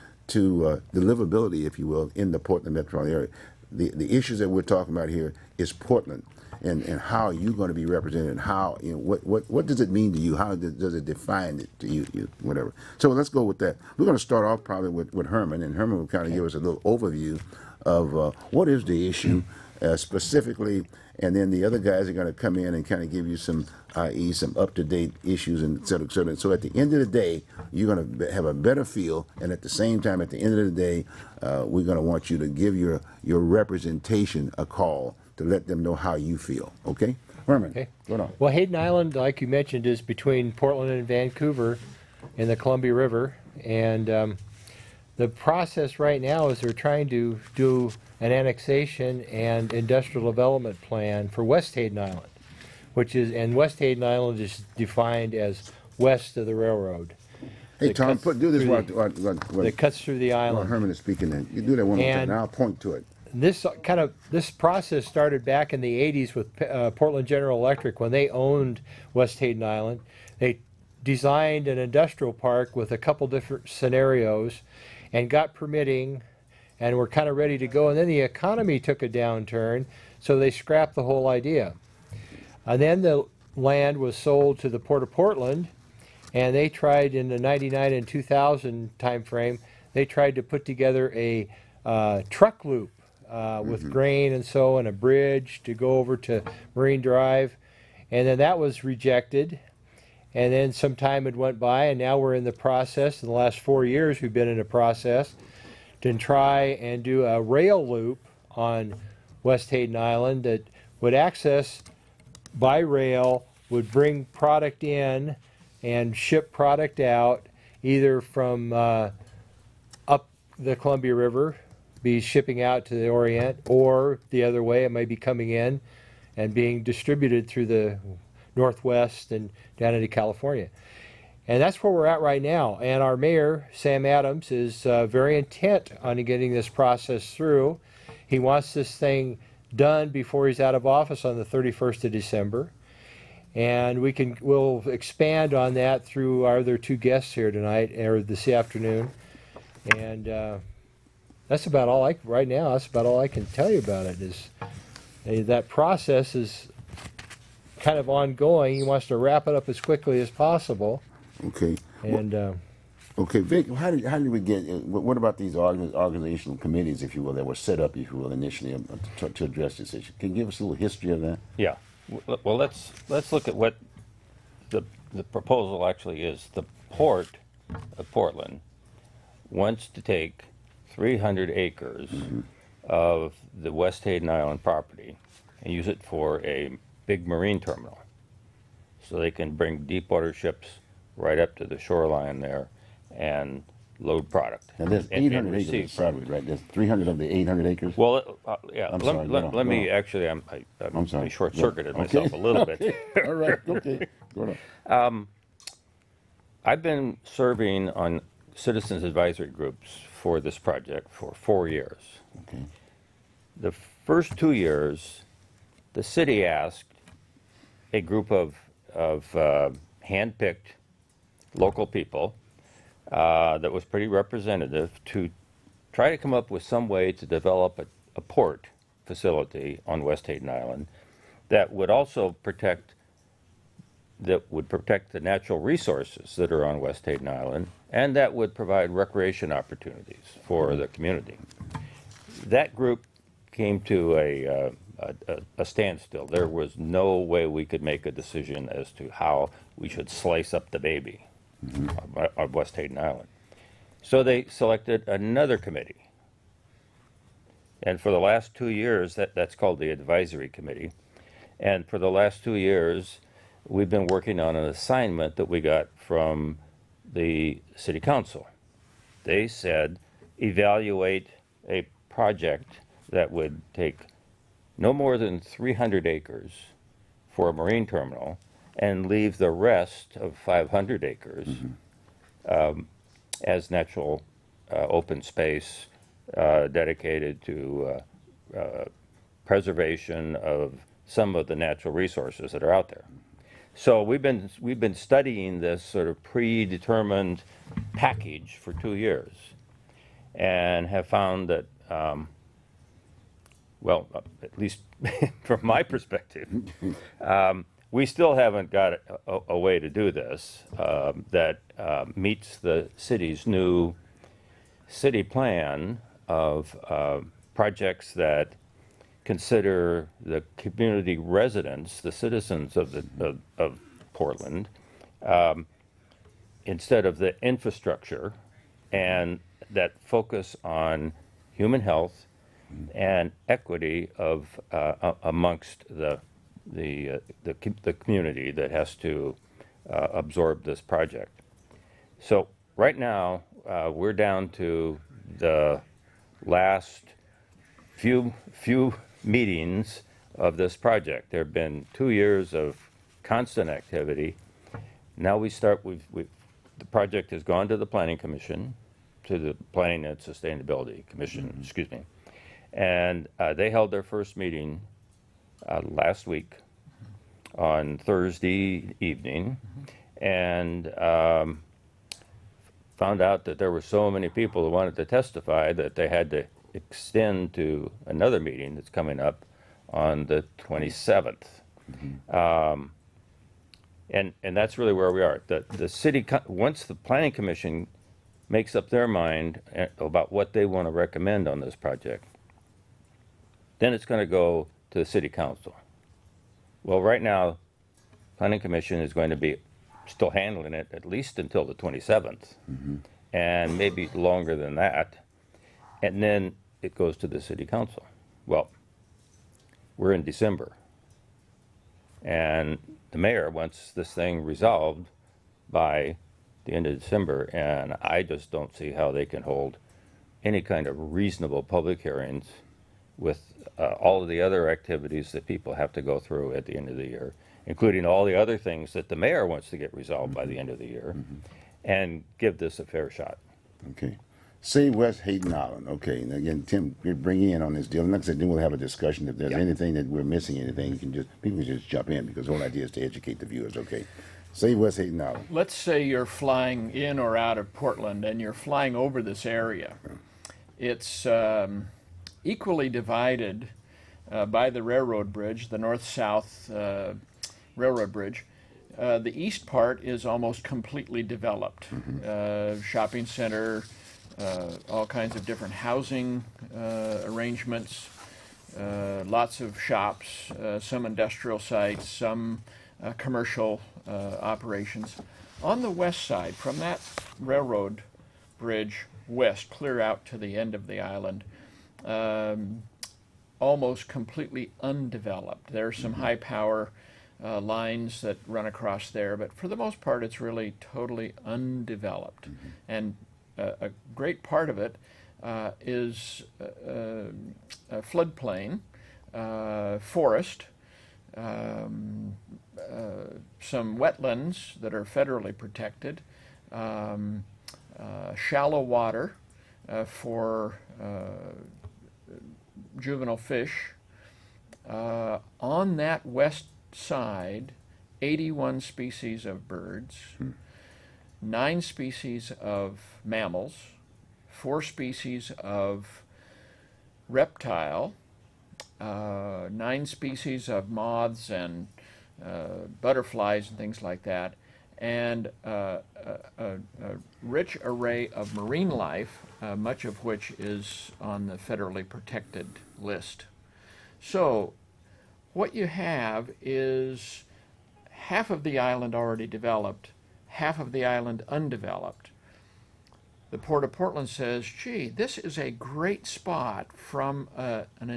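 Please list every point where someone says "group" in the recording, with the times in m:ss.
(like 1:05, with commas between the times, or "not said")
3:29, 3:37, 4:02.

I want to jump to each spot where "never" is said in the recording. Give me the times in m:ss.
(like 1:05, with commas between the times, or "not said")
not said.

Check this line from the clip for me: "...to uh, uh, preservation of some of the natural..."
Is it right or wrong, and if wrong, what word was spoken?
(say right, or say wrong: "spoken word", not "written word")
right.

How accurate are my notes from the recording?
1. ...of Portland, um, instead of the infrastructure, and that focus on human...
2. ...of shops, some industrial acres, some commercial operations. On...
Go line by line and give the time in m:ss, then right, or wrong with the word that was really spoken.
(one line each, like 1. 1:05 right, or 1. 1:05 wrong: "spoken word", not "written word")
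1. 5:23 right
2. 7:49 wrong: "sites", not "acres".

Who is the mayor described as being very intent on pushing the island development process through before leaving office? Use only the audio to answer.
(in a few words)
Sam Adams.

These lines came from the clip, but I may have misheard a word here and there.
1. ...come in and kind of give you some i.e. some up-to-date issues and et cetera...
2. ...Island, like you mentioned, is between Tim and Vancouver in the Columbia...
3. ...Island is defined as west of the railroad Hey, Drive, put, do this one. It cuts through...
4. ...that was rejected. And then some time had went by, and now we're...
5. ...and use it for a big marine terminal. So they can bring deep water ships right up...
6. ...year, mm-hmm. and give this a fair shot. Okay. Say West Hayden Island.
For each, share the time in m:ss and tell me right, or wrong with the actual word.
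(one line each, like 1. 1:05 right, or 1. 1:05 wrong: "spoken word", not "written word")
1. 0:22 right
2. 0:38 wrong: "Portland", not "Tim"
3. 0:54 wrong: "Tom", not "Drive"
4. 1:38 right
5. 3:05 right
6. 7:10 right.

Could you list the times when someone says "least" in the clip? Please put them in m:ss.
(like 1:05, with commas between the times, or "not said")
5:04, 6:41.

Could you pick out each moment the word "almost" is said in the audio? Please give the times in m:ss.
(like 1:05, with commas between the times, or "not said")
7:40, 8:03.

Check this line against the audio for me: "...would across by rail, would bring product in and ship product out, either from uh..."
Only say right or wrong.
wrong.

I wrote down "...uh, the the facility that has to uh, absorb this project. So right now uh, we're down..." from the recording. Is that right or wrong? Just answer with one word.
wrong.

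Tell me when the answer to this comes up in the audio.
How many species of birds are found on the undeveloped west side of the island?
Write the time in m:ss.
8:38.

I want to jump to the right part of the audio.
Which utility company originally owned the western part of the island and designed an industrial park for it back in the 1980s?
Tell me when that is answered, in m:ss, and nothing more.
1:06.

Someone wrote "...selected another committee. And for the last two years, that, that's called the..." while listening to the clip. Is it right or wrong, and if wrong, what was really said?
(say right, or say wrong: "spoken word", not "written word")
right.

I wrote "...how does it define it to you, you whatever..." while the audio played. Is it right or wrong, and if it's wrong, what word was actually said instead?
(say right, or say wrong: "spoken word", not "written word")
right.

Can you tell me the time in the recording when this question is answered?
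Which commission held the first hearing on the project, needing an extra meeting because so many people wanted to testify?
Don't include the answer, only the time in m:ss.
5:59.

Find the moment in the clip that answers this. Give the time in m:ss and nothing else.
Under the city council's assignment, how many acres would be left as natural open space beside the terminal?
4:40.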